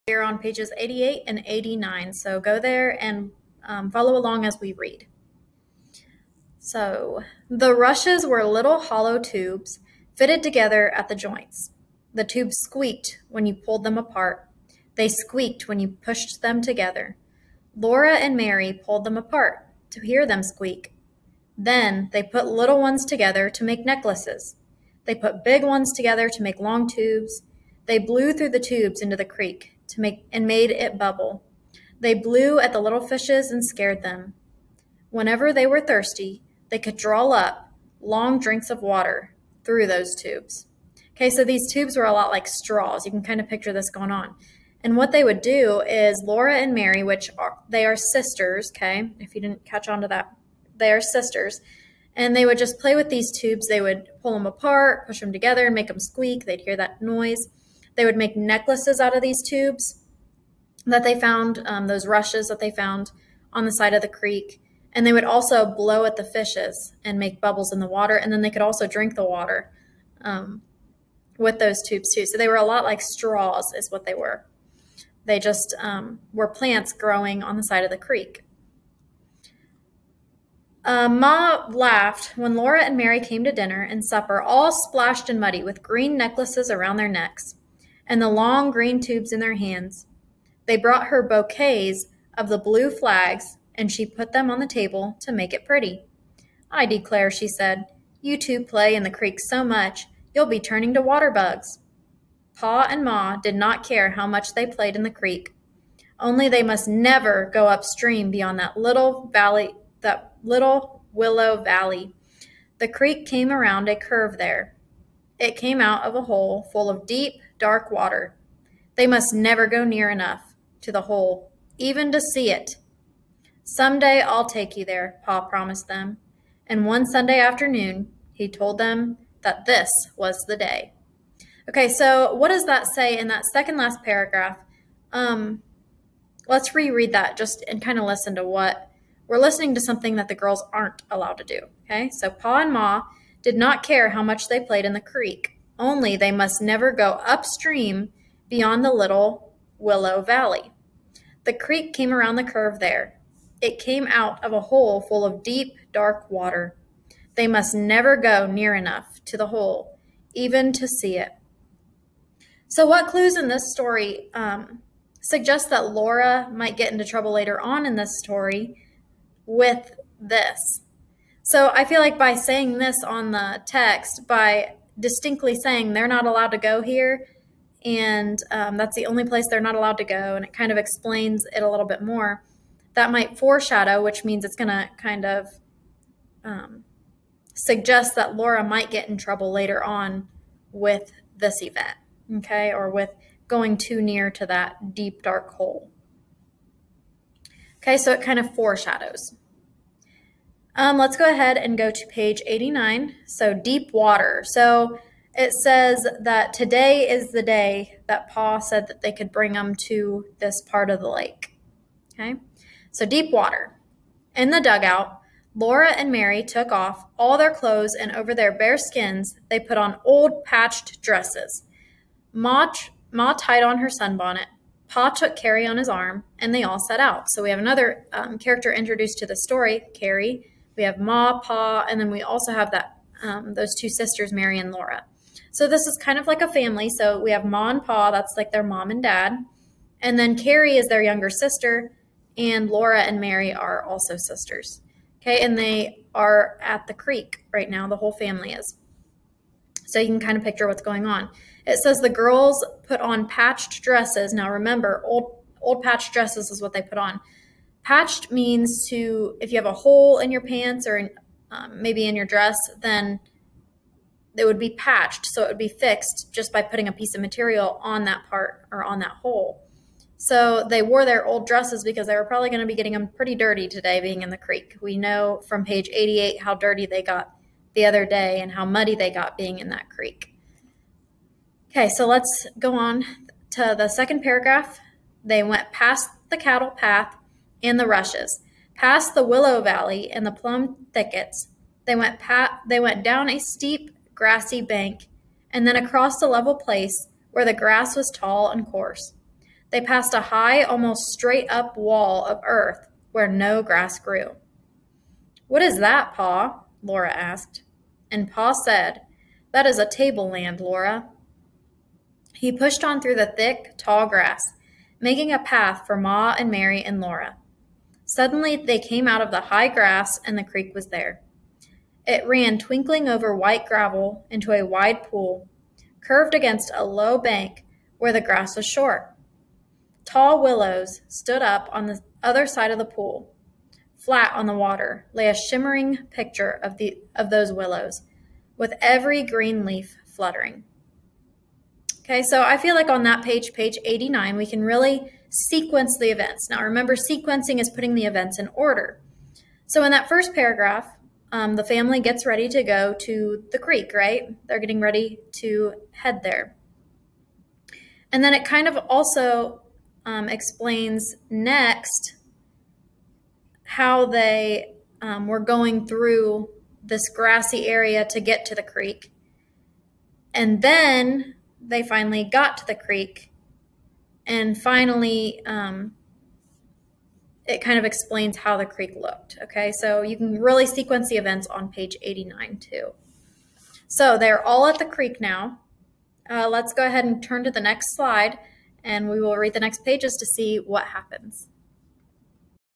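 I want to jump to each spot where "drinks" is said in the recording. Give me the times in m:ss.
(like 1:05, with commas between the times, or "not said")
0:38, 1:08.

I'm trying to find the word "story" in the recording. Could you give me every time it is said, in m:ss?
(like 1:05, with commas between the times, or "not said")
2:43, 2:48, 3:49.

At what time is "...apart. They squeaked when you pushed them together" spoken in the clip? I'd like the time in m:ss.
0:13.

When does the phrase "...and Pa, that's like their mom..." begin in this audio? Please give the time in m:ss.
3:57.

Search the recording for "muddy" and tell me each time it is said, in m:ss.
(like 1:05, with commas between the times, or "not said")
1:25, 4:38.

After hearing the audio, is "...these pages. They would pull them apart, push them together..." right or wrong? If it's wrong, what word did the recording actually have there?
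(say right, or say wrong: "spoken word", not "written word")
wrong: "tubes", not "pages".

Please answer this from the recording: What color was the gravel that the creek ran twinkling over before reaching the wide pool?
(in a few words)
White.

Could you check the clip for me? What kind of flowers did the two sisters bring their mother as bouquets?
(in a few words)
Blue flags.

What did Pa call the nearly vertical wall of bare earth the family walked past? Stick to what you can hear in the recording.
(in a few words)
A tableland.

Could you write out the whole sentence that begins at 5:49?
So in that first paragraph, um, the family gets ready to go to the creek, right?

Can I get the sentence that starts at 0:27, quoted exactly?
They blew through the tubes into the creek to make and made it bubble.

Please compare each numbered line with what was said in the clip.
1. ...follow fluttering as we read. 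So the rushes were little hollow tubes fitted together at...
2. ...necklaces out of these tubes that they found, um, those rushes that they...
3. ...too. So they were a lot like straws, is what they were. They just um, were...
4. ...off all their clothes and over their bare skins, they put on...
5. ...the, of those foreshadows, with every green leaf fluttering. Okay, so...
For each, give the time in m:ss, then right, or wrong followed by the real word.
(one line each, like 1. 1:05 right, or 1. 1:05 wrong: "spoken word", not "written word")
1. 0:03 wrong: "along", not "fluttering"
2. 0:58 right
3. 1:12 right
4. 3:36 right
5. 5:36 wrong: "willows", not "foreshadows".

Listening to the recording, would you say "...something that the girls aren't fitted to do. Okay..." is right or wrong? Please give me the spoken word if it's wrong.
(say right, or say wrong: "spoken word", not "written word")
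wrong: "allowed", not "fitted".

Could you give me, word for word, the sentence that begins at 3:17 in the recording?
Okay, so it kind of foreshadows.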